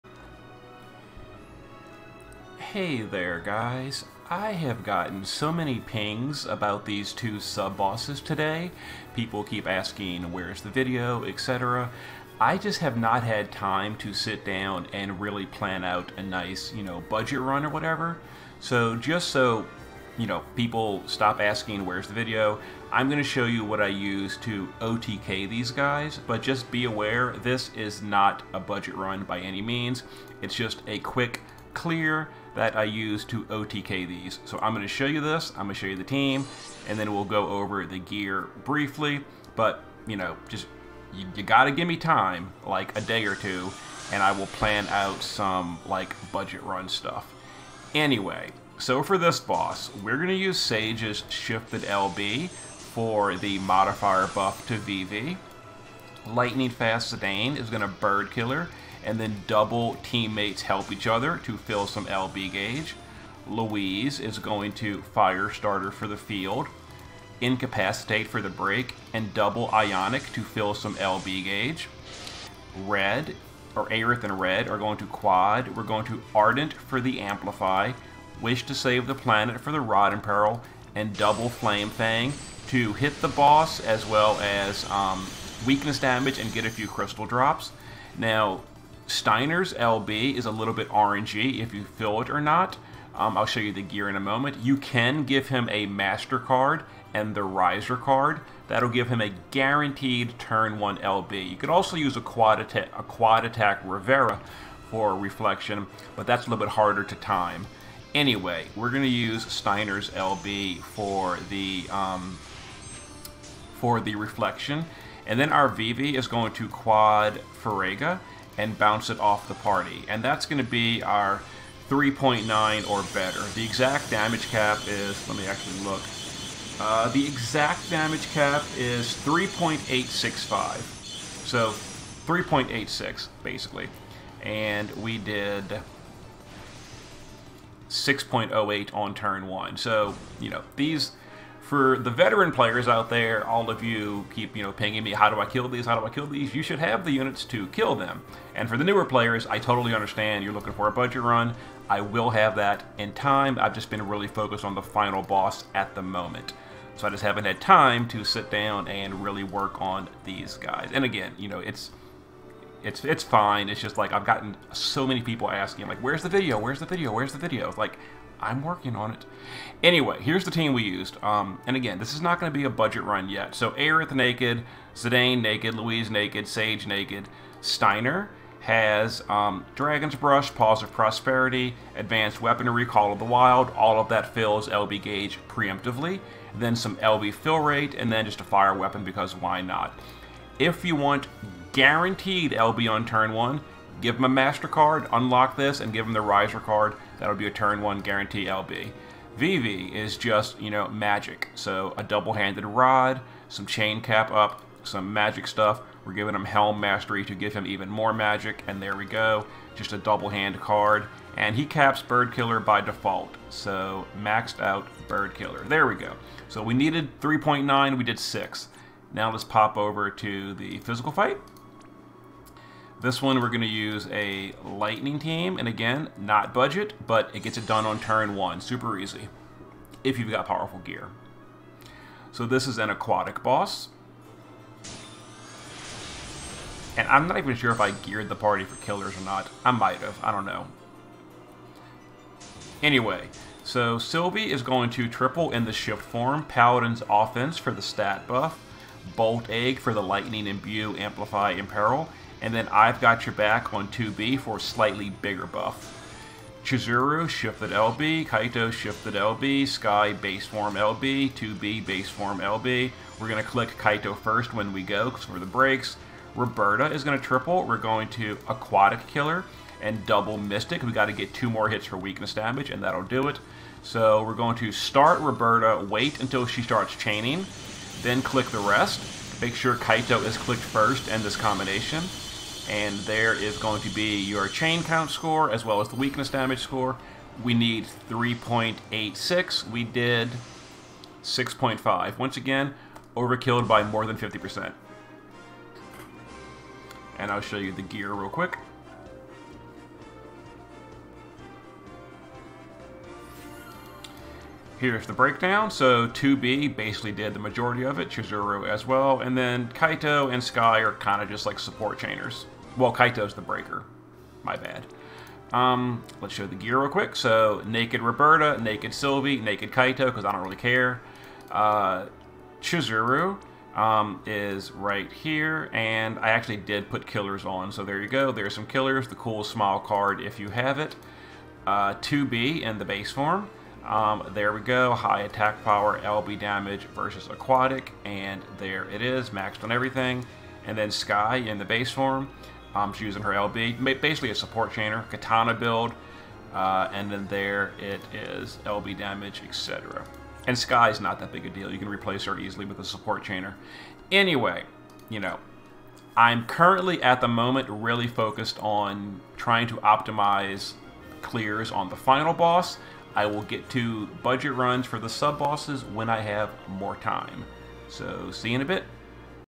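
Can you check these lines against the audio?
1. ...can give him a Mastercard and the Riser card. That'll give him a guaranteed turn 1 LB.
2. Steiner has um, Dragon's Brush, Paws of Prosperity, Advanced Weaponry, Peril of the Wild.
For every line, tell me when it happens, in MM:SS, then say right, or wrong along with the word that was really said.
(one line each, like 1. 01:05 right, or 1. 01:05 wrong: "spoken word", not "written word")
1. 01:34 right
2. 02:57 wrong: "Call", not "Peril".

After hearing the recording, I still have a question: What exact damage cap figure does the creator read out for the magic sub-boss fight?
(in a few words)
3.865.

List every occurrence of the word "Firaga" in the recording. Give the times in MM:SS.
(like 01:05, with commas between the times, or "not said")
01:57.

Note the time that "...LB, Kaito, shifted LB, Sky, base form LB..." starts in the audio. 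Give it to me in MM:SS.
04:17.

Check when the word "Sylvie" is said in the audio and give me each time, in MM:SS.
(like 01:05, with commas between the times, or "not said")
04:03, 05:18.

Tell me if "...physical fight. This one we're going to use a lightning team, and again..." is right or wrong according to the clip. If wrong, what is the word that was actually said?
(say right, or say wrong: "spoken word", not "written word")
right.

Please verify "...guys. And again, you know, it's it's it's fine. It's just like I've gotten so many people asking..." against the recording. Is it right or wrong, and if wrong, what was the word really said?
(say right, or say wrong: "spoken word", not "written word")
right.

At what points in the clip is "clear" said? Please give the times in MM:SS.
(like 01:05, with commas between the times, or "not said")
00:31, 06:01.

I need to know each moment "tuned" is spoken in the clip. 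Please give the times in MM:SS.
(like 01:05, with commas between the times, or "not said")
not said.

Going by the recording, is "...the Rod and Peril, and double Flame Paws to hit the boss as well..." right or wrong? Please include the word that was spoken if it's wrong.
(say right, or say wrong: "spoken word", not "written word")
wrong: "Fang", not "Paws".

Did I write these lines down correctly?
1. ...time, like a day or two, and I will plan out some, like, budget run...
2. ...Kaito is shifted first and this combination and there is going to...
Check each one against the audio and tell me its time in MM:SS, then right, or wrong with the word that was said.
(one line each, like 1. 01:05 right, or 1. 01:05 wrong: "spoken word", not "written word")
1. 00:41 right
2. 04:39 wrong: "clicked", not "shifted".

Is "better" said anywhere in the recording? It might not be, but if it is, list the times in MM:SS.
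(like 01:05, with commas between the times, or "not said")
02:03.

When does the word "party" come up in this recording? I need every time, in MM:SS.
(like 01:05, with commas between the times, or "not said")
01:59, 03:58.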